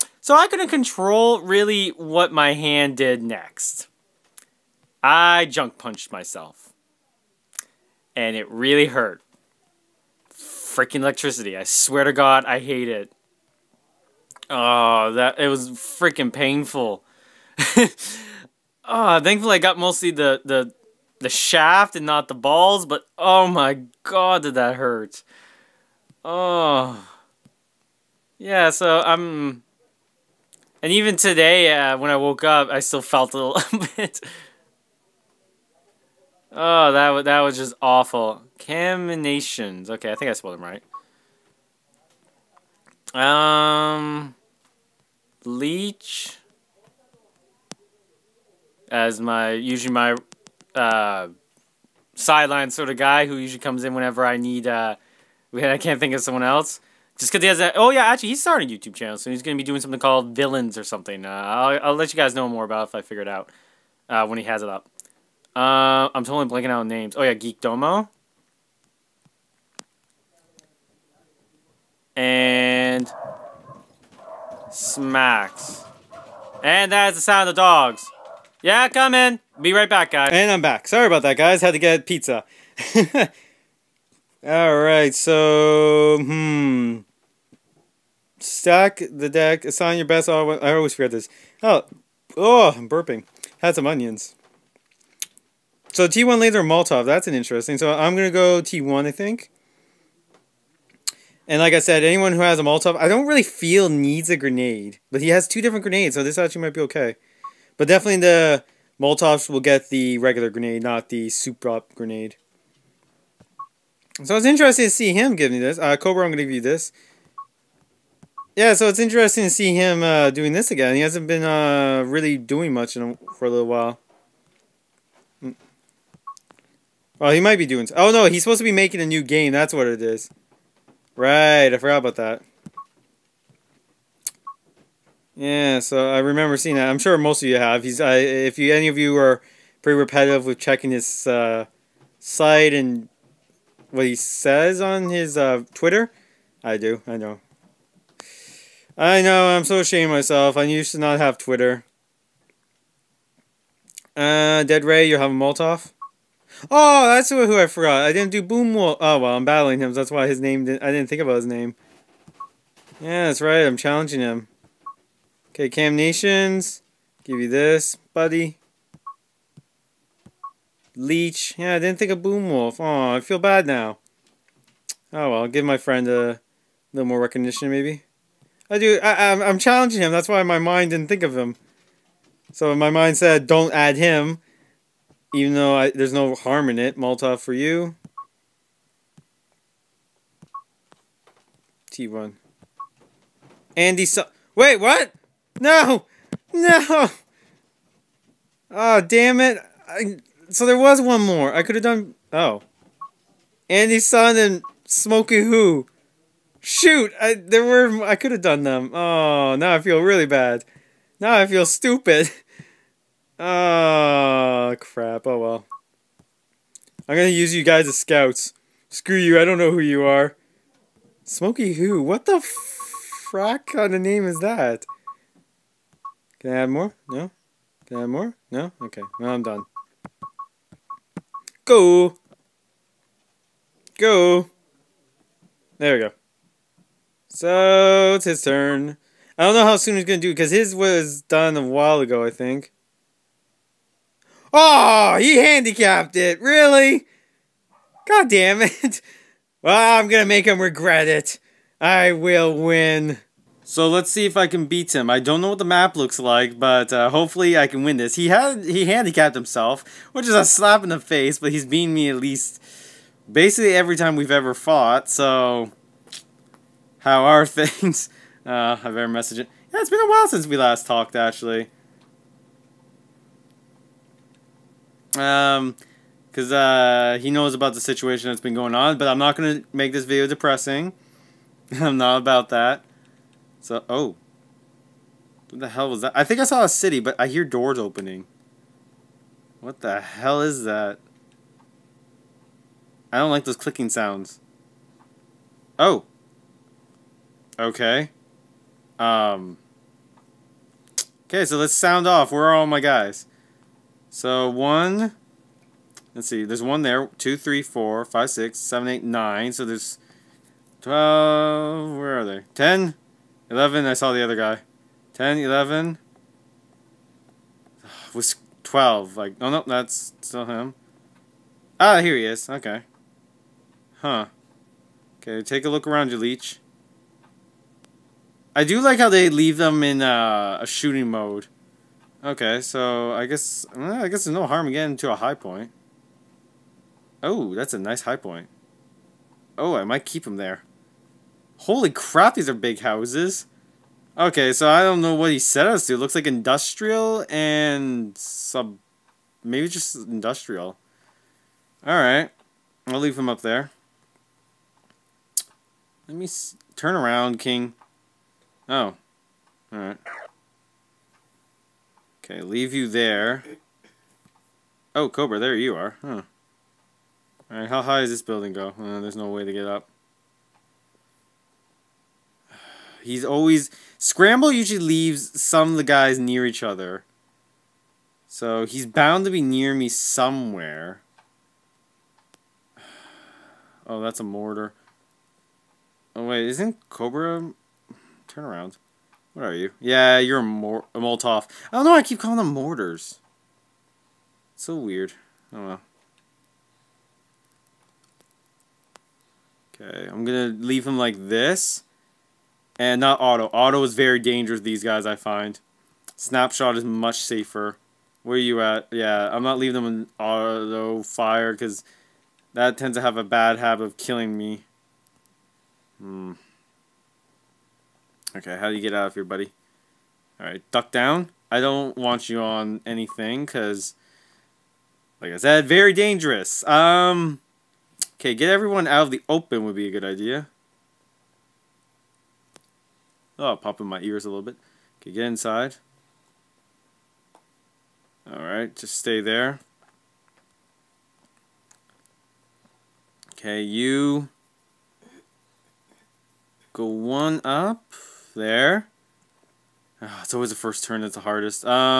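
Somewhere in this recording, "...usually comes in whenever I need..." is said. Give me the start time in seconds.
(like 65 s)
53 s.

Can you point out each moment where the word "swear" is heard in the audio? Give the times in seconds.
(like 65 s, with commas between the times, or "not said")
11 s.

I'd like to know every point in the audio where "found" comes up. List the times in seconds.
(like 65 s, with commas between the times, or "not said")
not said.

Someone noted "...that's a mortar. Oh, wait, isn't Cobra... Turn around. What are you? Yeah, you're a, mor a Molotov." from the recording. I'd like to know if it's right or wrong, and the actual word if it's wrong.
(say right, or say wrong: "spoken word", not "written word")
right.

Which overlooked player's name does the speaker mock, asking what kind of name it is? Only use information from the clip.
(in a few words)
Smokey Who.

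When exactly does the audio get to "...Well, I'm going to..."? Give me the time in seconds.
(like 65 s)
249 s.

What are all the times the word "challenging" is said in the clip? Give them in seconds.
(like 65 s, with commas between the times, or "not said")
163 s, 179 s.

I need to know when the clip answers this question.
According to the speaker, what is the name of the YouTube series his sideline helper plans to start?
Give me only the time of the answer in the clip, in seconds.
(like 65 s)
60 s.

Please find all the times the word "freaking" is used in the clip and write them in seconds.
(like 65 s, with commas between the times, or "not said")
10 s, 15 s.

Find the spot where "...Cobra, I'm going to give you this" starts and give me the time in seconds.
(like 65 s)
115 s.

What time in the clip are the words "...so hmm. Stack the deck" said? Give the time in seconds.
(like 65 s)
85 s.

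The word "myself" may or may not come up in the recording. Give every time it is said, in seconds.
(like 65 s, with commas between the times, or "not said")
6 s, 150 s.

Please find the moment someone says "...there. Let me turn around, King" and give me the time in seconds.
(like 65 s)
353 s.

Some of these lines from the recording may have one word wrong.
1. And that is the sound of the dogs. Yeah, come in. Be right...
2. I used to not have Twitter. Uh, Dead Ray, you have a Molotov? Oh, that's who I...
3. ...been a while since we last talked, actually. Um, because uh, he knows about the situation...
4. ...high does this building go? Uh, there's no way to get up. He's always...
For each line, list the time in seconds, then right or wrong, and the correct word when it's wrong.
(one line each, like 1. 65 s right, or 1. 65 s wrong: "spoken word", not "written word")
1. 76 s right
2. 150 s right
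3. 269 s right
4. 367 s right.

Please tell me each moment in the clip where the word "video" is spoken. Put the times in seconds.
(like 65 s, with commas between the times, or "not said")
280 s.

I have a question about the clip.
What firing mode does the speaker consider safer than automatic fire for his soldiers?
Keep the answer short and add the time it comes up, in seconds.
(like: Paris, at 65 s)
Snapshot, at 406 s.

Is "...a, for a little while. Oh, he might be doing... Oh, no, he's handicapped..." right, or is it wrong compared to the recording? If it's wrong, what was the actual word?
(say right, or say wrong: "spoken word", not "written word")
wrong: "supposed", not "handicapped".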